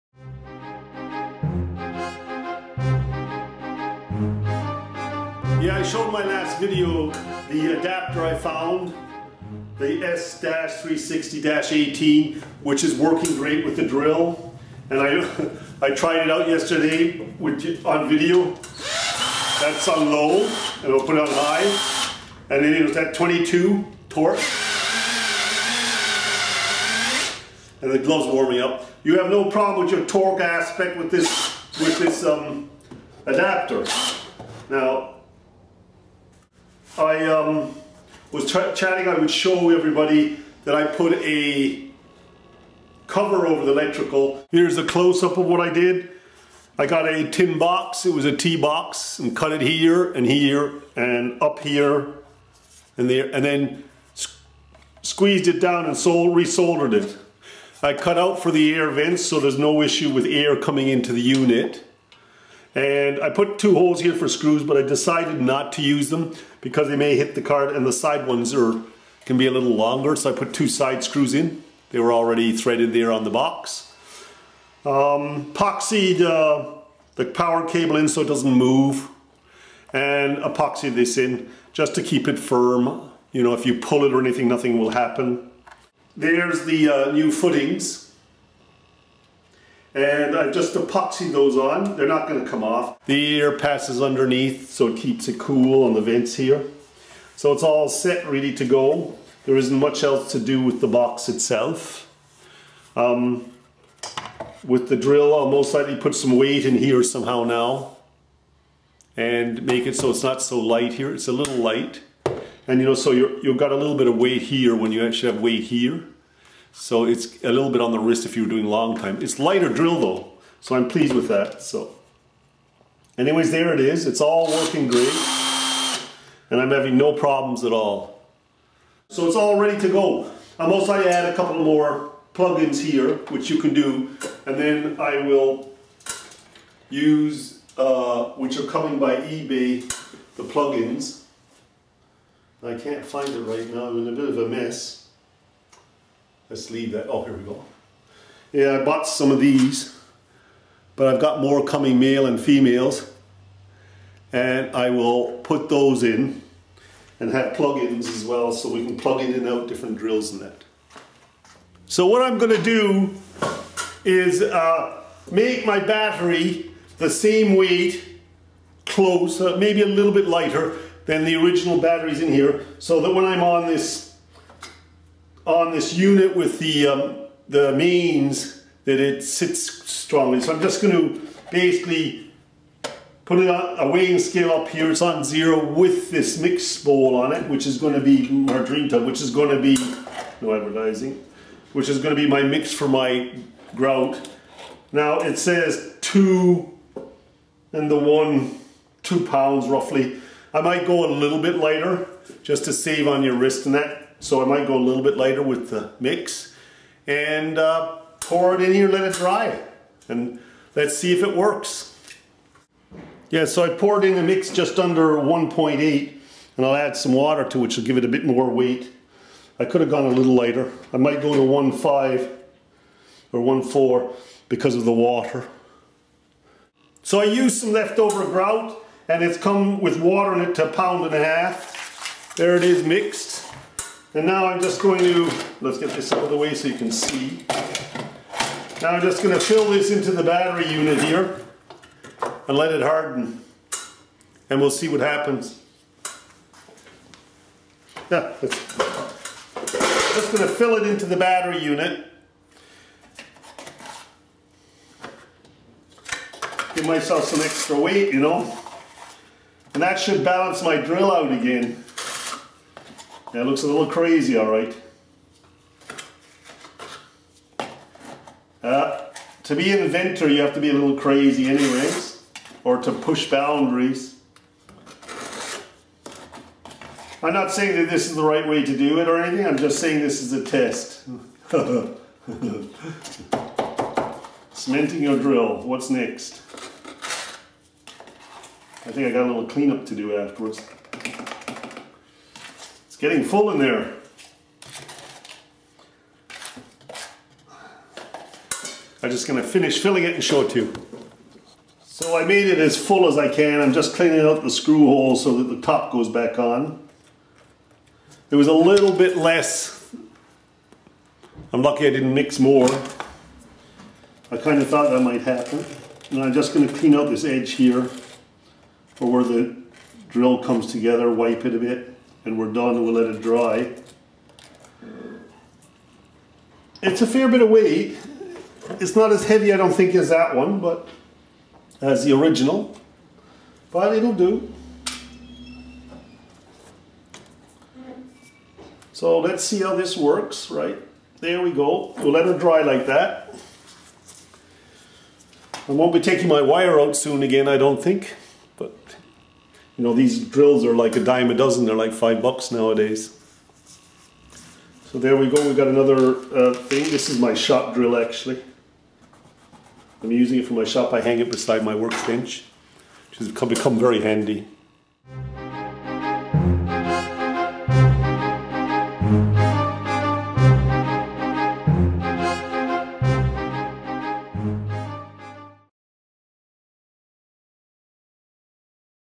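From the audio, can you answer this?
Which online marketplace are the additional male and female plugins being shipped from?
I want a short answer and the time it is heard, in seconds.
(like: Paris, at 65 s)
eBay, at 139 s.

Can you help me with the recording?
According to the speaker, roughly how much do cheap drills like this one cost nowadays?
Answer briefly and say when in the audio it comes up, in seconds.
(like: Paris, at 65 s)
5 bucks, at 351 s.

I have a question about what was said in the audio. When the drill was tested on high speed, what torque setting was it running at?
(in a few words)
22.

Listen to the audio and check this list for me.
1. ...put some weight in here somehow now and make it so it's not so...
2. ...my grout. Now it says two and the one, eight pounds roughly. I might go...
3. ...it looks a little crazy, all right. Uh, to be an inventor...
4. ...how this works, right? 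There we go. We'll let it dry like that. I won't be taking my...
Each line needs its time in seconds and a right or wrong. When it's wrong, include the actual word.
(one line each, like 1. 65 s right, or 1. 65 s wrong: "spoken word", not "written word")
1. 105 s right
2. 192 s wrong: "two", not "eight"
3. 263 s right
4. 339 s right.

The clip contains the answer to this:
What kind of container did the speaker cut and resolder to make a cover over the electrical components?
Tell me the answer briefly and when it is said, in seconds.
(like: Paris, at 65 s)
tin box, at 47 s.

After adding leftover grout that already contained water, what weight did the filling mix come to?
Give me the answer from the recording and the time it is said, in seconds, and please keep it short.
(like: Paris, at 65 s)
a pound and a half, at 230 s.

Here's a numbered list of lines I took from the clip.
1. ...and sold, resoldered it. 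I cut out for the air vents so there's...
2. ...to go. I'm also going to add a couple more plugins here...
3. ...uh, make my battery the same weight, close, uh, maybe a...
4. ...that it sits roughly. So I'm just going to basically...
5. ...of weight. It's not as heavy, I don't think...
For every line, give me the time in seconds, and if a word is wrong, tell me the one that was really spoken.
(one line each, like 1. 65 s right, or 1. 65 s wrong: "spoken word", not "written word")
1. 55 s right
2. 129 s right
3. 164 s right
4. 178 s wrong: "strongly", not "roughly"
5. 327 s right.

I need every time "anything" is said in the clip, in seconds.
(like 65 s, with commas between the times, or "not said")
84 s, 279 s.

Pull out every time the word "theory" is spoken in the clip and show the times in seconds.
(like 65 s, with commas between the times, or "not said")
not said.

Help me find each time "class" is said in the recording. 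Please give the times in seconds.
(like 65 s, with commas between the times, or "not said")
not said.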